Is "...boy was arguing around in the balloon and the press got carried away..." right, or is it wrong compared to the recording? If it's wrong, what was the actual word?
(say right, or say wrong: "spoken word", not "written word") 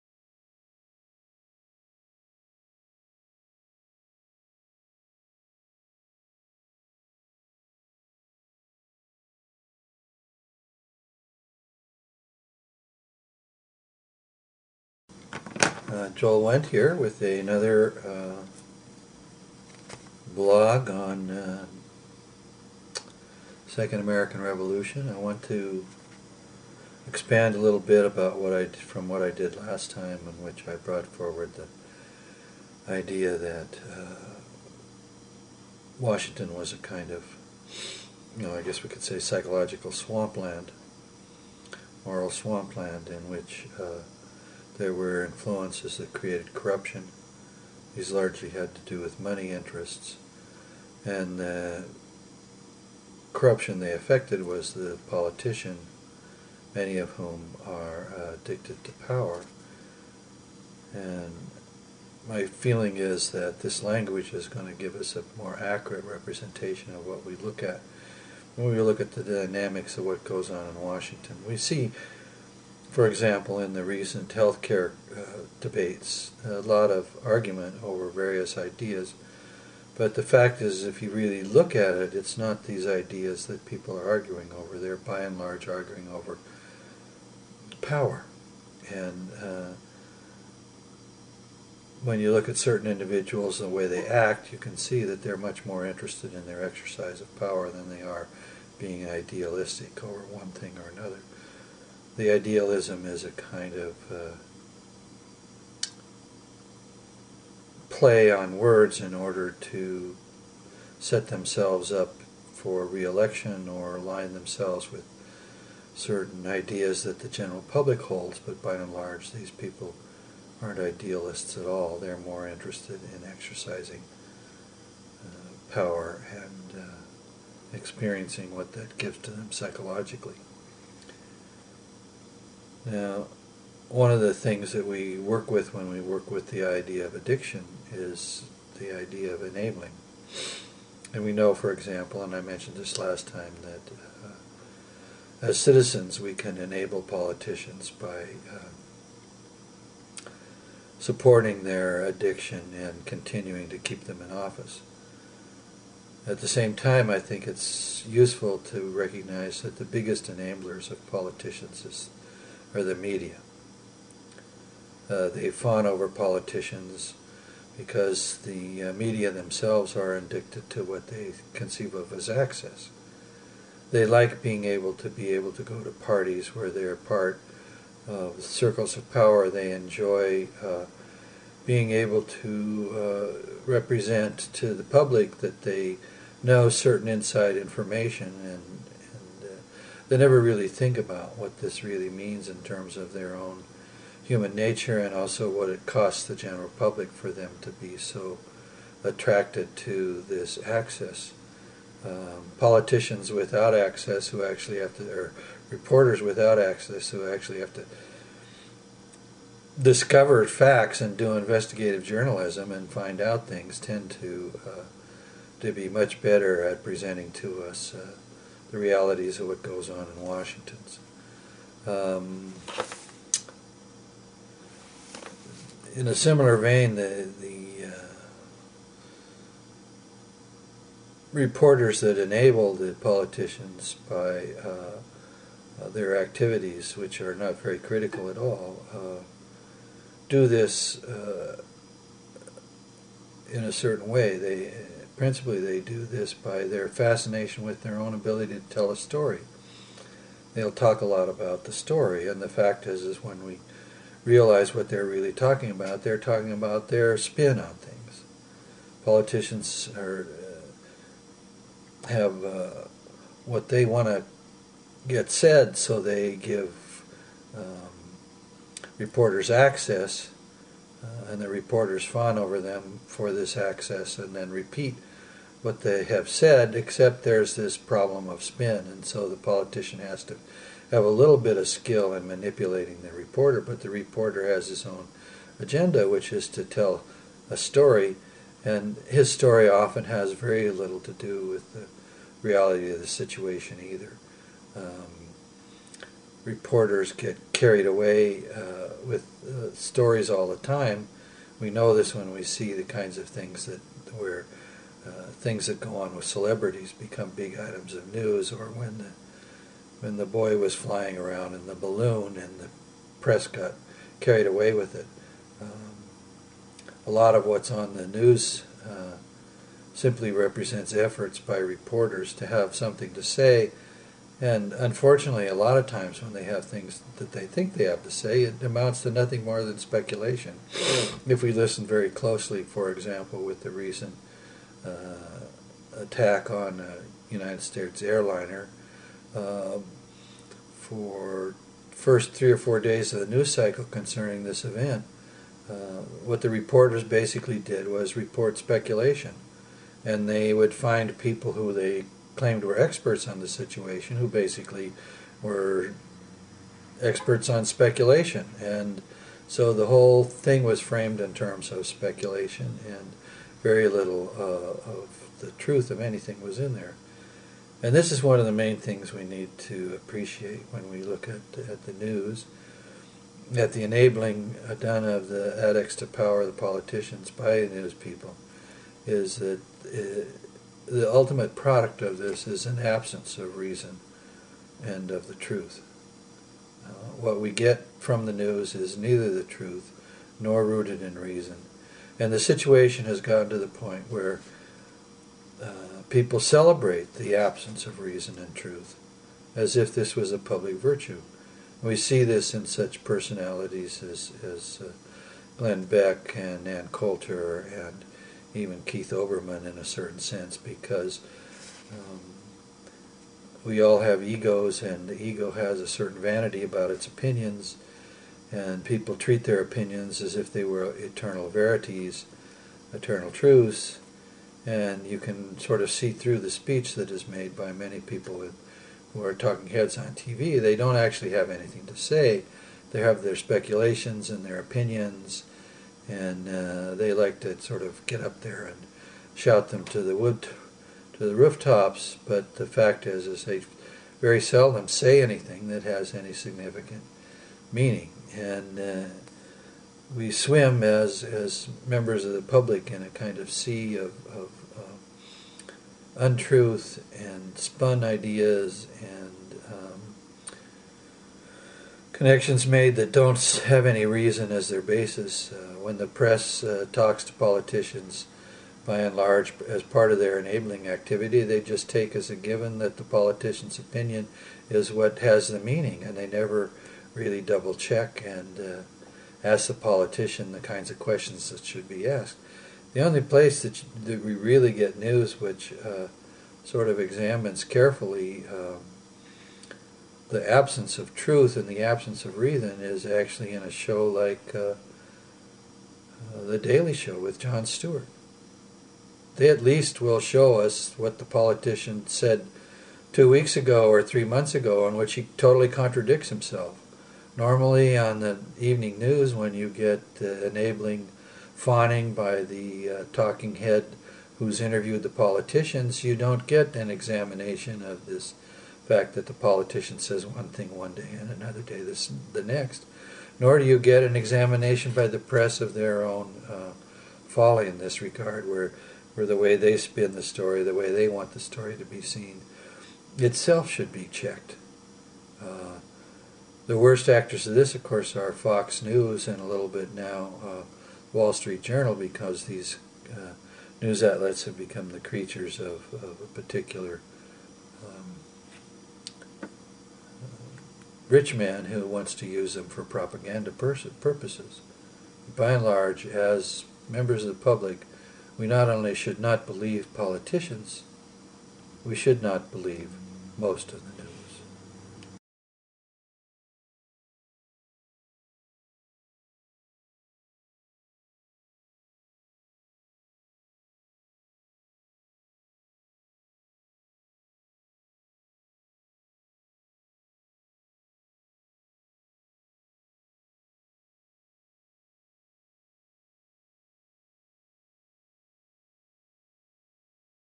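wrong: "flying", not "arguing".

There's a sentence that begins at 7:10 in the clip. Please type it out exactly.
They don't actually have anything to say.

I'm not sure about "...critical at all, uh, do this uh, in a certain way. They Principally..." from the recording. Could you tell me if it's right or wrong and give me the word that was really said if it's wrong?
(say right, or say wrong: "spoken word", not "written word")
right.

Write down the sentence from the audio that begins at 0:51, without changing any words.
And the uh, corruption they affected was the politician, many of whom are uh, addicted to power.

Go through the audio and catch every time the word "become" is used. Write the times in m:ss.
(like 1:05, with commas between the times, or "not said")
5:06, 9:04.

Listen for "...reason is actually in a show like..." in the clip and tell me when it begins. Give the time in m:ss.
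8:12.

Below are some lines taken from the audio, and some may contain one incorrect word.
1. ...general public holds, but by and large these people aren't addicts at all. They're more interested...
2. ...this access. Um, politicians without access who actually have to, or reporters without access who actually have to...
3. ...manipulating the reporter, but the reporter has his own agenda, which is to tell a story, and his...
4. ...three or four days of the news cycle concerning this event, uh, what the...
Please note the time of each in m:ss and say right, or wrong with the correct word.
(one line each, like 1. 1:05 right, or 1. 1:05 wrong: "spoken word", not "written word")
1. 1:57 wrong: "idealists", not "addicts"
2. 3:20 right
3. 4:42 right
4. 5:42 right.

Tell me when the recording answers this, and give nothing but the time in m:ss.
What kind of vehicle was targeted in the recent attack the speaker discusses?
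5:37.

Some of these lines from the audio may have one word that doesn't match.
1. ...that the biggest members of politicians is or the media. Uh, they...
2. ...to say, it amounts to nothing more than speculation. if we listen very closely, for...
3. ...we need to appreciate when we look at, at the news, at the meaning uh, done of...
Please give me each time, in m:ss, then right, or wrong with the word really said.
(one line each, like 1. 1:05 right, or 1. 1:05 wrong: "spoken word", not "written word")
1. 2:39 wrong: "enablers", not "members"
2. 5:28 right
3. 6:09 wrong: "enabling", not "meaning".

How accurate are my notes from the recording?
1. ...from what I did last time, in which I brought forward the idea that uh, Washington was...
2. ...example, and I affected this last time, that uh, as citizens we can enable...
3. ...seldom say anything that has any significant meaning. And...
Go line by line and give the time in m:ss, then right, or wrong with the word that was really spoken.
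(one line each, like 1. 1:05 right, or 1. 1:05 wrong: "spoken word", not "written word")
1. 0:28 right
2. 2:21 wrong: "mentioned", not "affected"
3. 7:24 right.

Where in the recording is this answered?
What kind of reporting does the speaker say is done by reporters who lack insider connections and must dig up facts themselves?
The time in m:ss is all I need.
3:31.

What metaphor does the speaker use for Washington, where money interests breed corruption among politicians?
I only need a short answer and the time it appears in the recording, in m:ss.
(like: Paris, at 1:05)
moral swampland, at 0:42.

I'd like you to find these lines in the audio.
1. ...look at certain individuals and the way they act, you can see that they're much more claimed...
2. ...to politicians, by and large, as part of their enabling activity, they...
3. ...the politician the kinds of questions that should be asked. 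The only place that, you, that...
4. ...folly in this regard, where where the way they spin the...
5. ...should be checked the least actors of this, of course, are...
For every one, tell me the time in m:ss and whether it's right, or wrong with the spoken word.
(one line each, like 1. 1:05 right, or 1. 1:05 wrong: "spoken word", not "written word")
1. 1:32 wrong: "interested", not "claimed"
2. 7:47 right
3. 7:59 right
4. 8:47 right
5. 8:53 wrong: "worst", not "least".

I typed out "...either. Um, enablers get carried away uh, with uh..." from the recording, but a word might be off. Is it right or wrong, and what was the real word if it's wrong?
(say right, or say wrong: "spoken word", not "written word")
wrong: "reporters", not "enablers".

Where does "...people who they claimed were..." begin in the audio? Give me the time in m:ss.
5:51.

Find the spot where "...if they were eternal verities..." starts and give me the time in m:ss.
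7:00.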